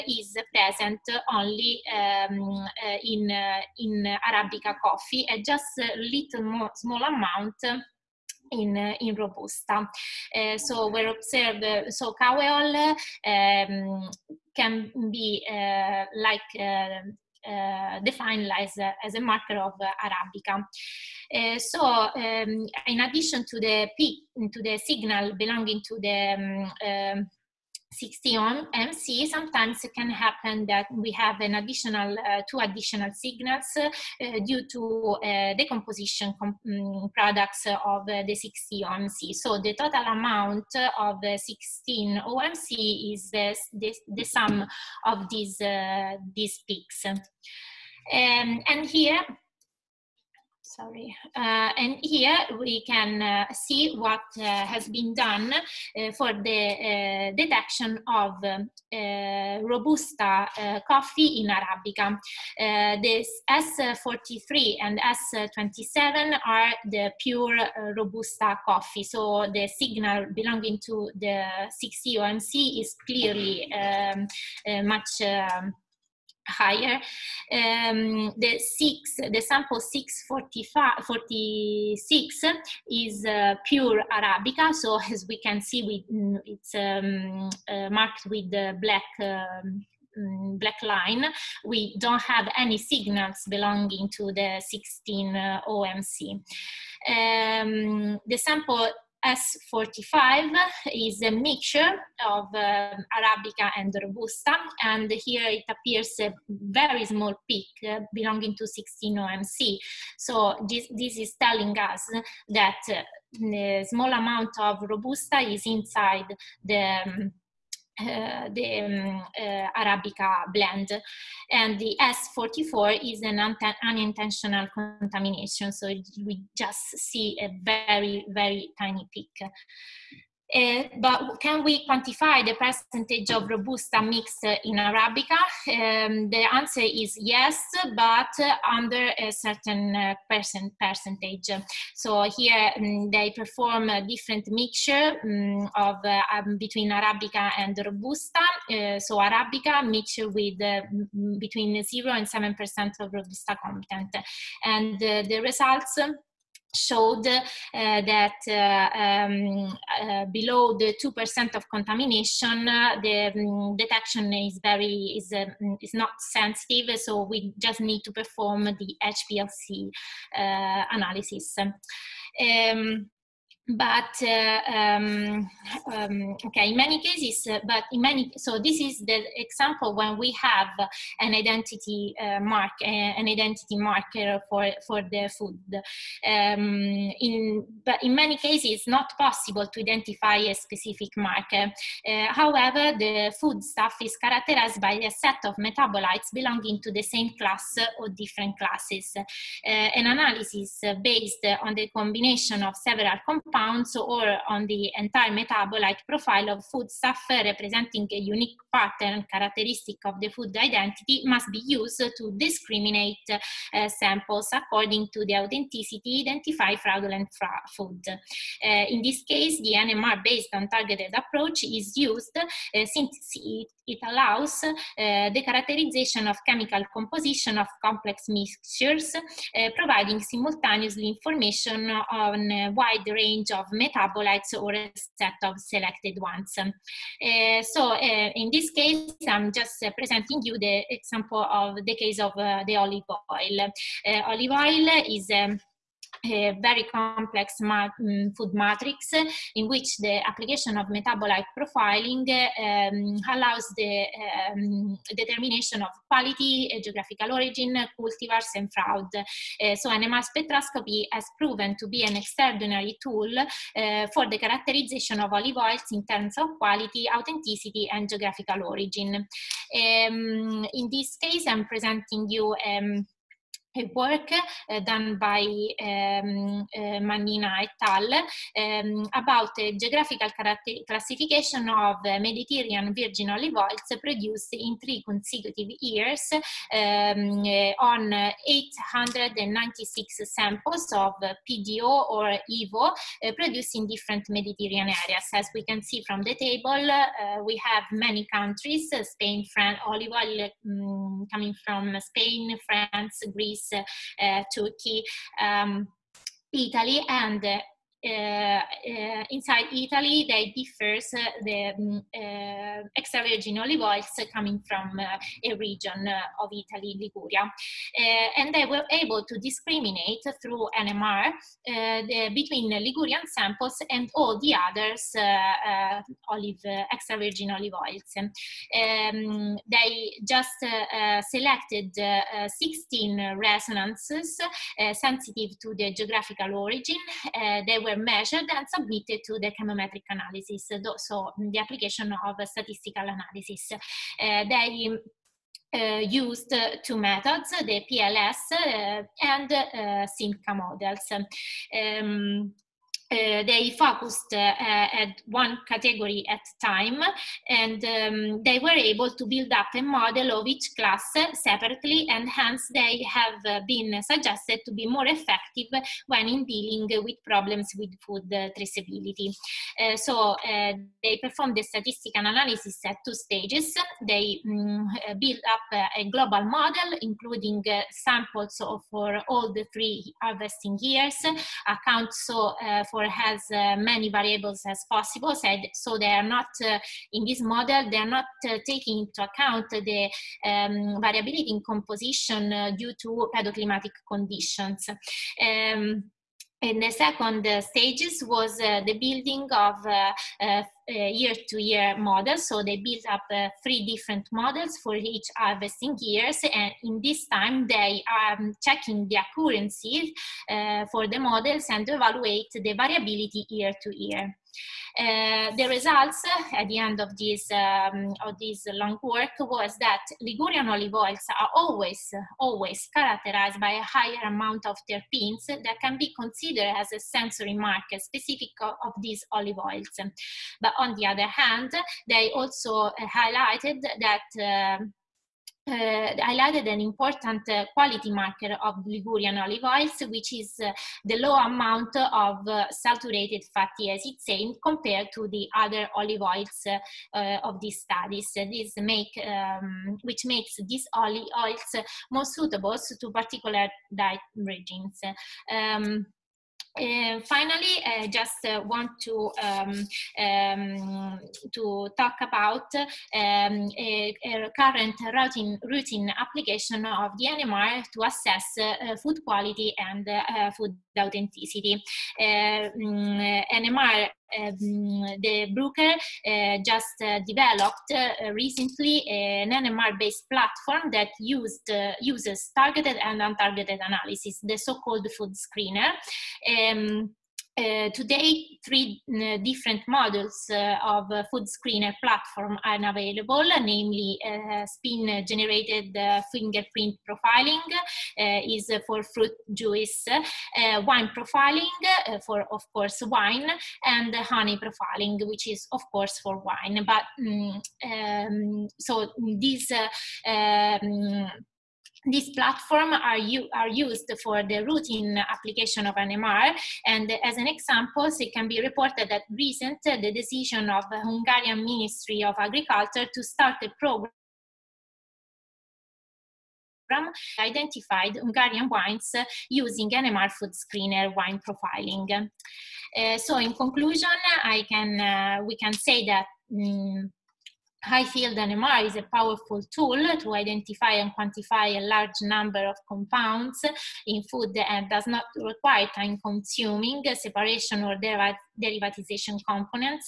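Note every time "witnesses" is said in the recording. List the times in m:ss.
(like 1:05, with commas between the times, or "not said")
not said.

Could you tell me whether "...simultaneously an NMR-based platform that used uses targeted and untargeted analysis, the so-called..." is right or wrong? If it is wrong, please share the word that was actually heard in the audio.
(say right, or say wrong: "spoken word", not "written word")
wrong: "recently", not "simultaneously".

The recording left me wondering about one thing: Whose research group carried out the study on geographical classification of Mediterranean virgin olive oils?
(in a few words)
Mannina et al.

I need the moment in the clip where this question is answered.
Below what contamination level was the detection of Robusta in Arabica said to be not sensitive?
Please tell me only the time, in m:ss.
2:41.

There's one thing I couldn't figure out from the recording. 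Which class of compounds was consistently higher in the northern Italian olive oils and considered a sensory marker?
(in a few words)
Terpenes.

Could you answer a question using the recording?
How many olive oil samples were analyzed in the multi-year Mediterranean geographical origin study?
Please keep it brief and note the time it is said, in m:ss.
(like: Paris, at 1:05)
896, at 4:48.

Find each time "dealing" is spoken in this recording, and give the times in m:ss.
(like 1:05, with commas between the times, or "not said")
6:06.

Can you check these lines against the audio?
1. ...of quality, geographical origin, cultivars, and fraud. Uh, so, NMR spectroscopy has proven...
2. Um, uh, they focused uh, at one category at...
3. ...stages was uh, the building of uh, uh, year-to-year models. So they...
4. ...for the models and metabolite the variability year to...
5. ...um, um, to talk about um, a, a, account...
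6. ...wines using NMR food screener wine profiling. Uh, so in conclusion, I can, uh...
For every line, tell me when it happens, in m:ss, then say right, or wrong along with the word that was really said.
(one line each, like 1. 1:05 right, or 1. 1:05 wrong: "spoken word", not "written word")
1. 4:15 right
2. 5:51 right
3. 6:37 right
4. 6:50 wrong: "evaluate", not "metabolite"
5. 7:39 wrong: "current", not "account"
6. 8:48 right.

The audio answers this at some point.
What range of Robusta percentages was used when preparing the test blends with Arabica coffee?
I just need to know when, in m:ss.
2:31.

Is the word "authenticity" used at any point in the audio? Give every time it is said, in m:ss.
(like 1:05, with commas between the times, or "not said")
3:35, 4:27, 7:50.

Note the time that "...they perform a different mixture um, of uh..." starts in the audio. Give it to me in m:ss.
2:23.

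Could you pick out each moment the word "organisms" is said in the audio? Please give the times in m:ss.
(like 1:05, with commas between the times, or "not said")
not said.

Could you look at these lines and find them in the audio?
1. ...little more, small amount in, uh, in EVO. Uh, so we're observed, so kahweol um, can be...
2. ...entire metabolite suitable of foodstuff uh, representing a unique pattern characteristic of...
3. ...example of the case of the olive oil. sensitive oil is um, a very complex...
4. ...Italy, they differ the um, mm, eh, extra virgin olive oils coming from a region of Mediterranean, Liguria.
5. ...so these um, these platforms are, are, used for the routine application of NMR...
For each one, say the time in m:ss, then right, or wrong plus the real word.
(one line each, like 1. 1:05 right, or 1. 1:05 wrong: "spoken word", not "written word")
1. 0:05 wrong: "Robusta", not "EVO"
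2. 3:24 wrong: "profile", not "suitable"
3. 4:00 wrong: "olive", not "sensitive"
4. 5:09 wrong: "Italy", not "Mediterranean"
5. 8:28 right.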